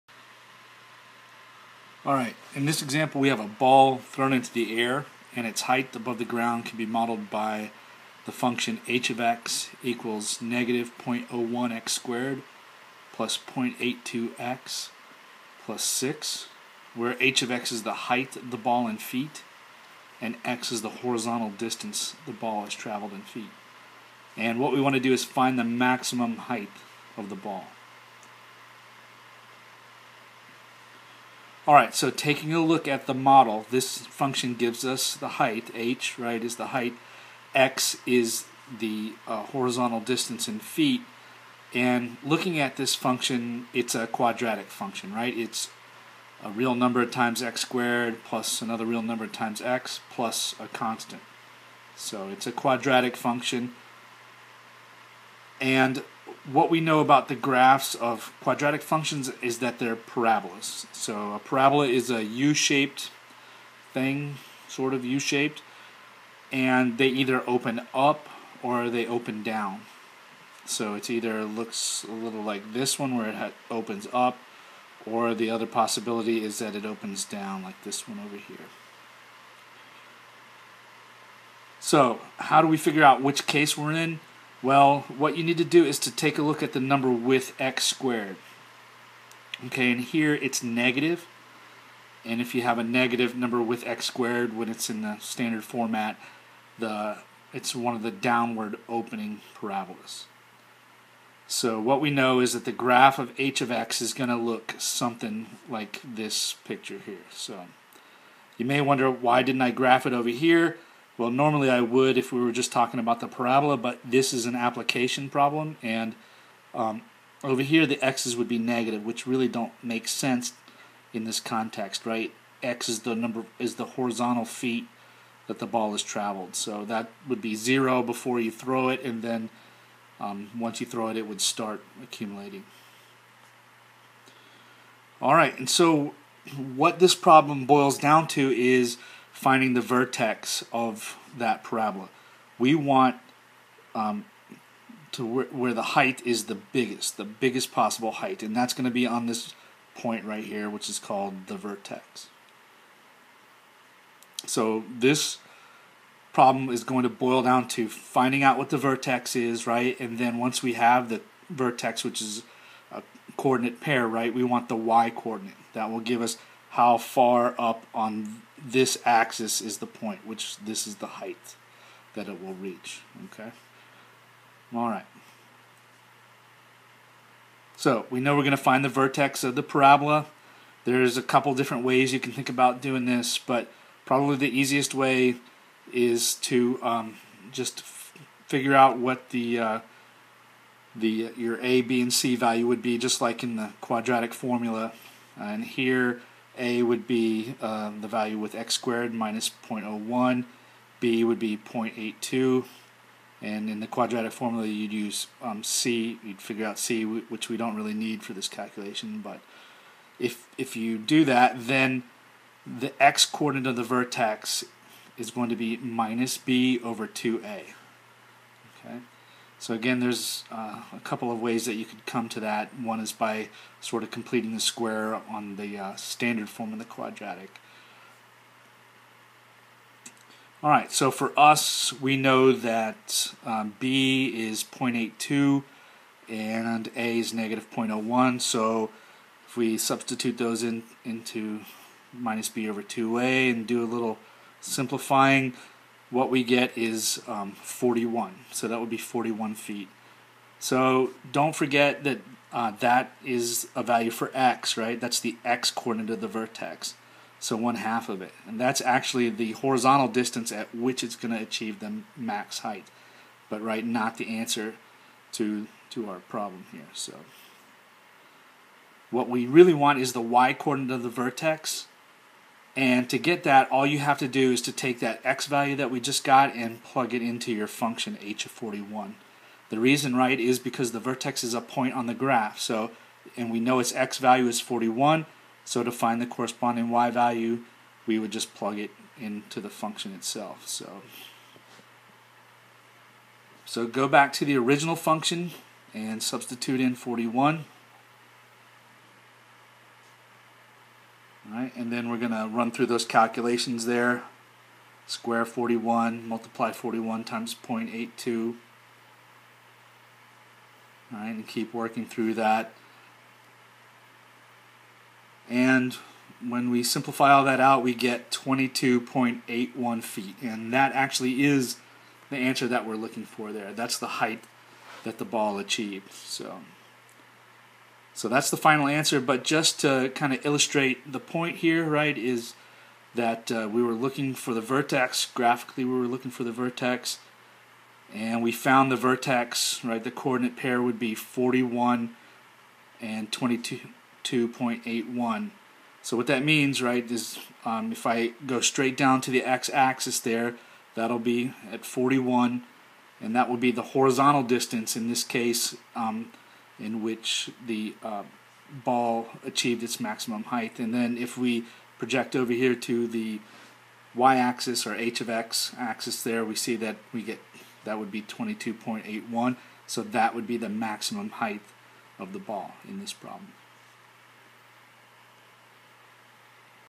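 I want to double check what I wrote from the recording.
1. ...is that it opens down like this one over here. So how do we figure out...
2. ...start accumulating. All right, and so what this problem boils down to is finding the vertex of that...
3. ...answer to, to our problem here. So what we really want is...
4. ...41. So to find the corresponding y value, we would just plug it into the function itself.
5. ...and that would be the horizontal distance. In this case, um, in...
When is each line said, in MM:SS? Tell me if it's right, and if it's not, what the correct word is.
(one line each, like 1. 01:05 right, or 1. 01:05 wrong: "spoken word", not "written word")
1. 01:16 right
2. 02:11 right
3. 04:24 right
4. 04:44 right
5. 05:53 right.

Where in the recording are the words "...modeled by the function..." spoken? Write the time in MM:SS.
00:06.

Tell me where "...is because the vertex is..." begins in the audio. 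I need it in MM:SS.
04:40.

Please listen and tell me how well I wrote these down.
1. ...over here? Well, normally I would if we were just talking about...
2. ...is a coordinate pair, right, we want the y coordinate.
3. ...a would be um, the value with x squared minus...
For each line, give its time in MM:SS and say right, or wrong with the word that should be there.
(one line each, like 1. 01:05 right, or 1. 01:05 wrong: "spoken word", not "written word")
1. 01:50 right
2. 02:42 right
3. 03:16 right.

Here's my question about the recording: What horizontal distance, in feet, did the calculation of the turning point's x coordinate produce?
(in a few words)
41 feet.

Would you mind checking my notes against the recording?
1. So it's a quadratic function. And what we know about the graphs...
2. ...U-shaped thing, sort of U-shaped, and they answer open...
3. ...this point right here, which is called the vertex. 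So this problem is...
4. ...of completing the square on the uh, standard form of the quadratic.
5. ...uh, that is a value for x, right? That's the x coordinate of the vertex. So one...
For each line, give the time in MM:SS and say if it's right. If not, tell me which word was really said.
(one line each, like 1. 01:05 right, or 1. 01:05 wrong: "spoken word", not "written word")
1. 00:51 right
2. 01:02 wrong: "either", not "answer"
3. 02:29 right
4. 03:44 right
5. 04:12 right.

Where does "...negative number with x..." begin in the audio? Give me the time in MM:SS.
01:32.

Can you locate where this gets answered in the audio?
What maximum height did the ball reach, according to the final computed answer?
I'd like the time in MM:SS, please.
05:18.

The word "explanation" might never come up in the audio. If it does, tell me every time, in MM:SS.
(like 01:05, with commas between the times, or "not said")
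not said.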